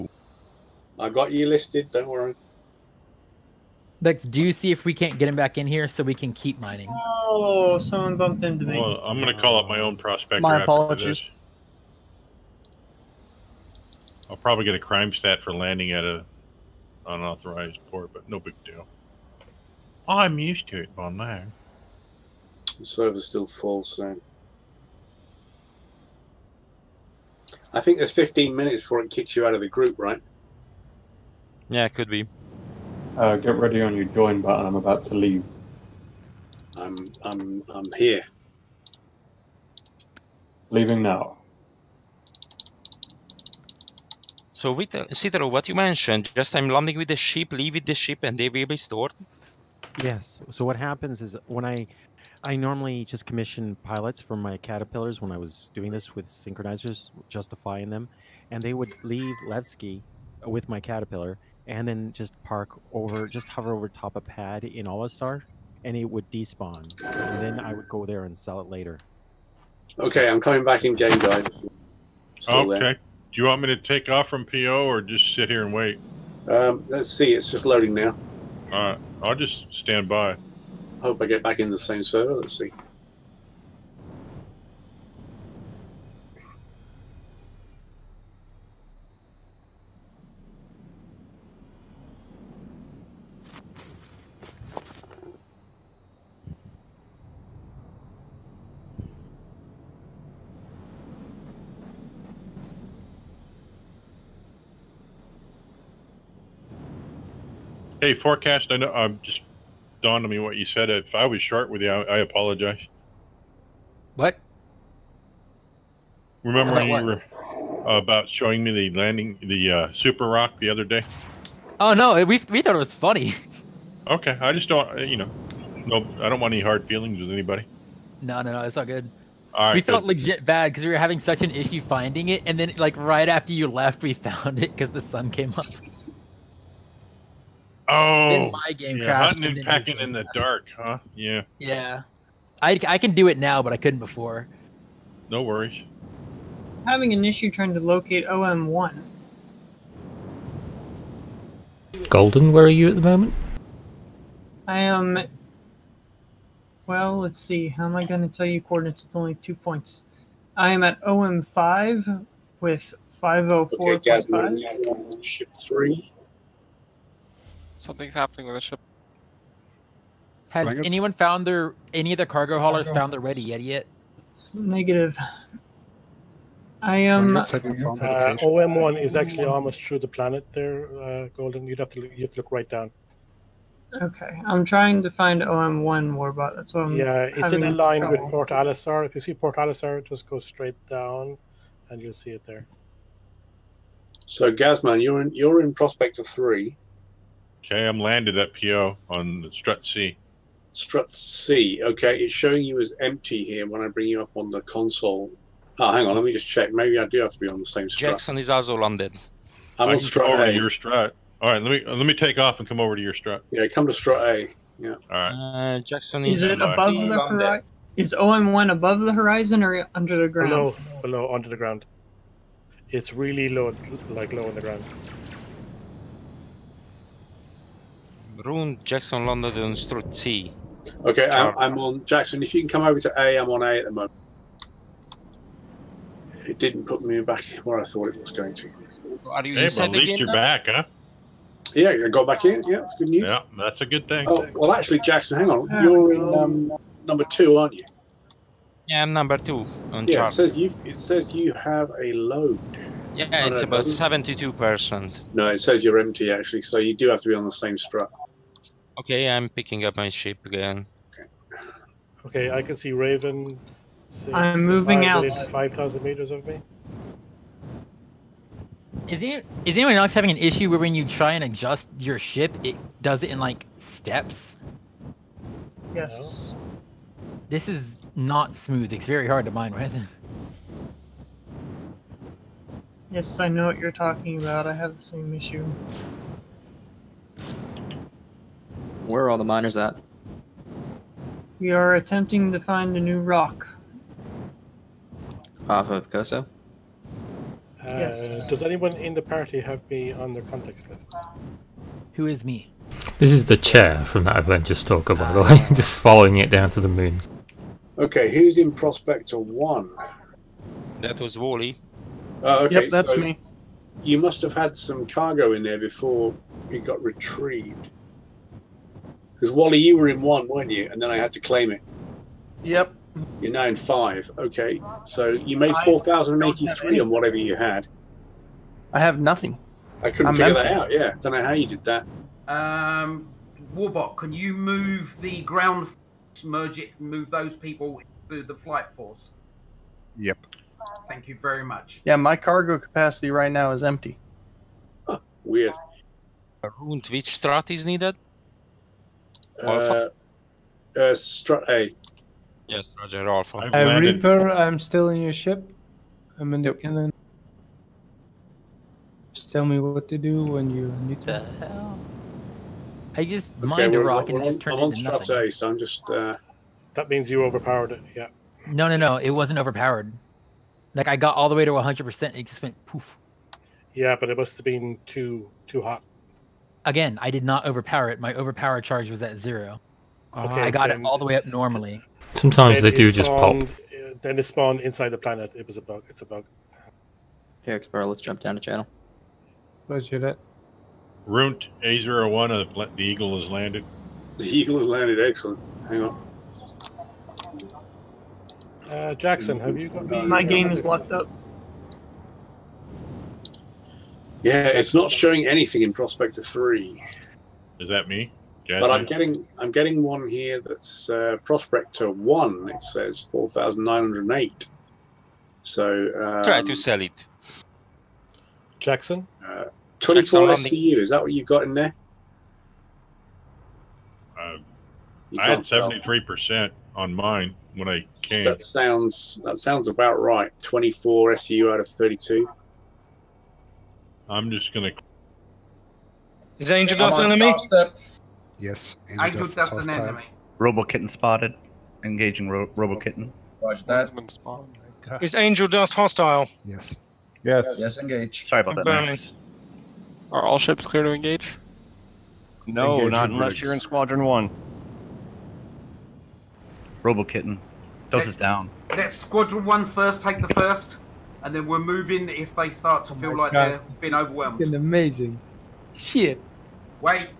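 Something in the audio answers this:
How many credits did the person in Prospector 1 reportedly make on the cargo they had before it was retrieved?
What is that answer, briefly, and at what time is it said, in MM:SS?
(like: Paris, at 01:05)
4083, at 05:25.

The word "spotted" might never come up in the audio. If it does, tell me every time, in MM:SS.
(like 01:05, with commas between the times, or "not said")
07:21.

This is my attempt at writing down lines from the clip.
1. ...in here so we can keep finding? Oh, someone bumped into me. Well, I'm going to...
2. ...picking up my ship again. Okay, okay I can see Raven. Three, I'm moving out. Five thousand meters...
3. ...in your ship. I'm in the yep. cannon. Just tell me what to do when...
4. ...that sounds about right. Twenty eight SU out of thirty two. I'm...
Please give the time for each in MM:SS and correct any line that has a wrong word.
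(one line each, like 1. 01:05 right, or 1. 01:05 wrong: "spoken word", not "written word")
1. 00:05 wrong: "mining", not "finding"
2. 04:19 wrong: "Six", not "Three"
3. 05:55 right
4. 07:09 wrong: "four", not "eight".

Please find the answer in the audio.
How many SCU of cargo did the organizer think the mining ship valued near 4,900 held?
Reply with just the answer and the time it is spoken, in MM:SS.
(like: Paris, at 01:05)
24, at 07:00.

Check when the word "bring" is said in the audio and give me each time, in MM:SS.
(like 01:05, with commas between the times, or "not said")
03:23.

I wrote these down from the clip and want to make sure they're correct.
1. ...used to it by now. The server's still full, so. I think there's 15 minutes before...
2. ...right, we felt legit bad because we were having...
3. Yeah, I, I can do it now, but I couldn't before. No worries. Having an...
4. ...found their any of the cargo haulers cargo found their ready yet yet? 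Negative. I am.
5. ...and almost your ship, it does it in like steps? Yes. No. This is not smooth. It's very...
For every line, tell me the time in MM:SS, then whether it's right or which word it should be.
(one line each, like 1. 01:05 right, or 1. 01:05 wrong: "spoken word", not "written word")
1. 00:20 right
2. 02:09 right
3. 02:21 right
4. 02:51 right
5. 04:31 wrong: "adjust", not "almost".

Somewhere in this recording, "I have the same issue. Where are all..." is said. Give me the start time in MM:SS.
04:44.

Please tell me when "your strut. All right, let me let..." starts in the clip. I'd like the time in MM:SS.
03:30.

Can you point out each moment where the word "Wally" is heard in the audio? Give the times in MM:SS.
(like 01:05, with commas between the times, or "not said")
05:11, 05:19.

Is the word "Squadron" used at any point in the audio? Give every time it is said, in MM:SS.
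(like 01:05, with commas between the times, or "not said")
07:33, 07:39.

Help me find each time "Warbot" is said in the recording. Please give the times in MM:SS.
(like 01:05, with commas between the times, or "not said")
03:06, 05:33.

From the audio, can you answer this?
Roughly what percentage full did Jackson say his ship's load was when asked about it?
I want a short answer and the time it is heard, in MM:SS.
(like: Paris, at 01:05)
72%, at 04:13.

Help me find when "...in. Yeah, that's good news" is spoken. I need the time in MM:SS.
04:02.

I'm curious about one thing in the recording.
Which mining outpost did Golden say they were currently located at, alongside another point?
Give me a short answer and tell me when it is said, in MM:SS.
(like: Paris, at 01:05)
OM5, at 02:41.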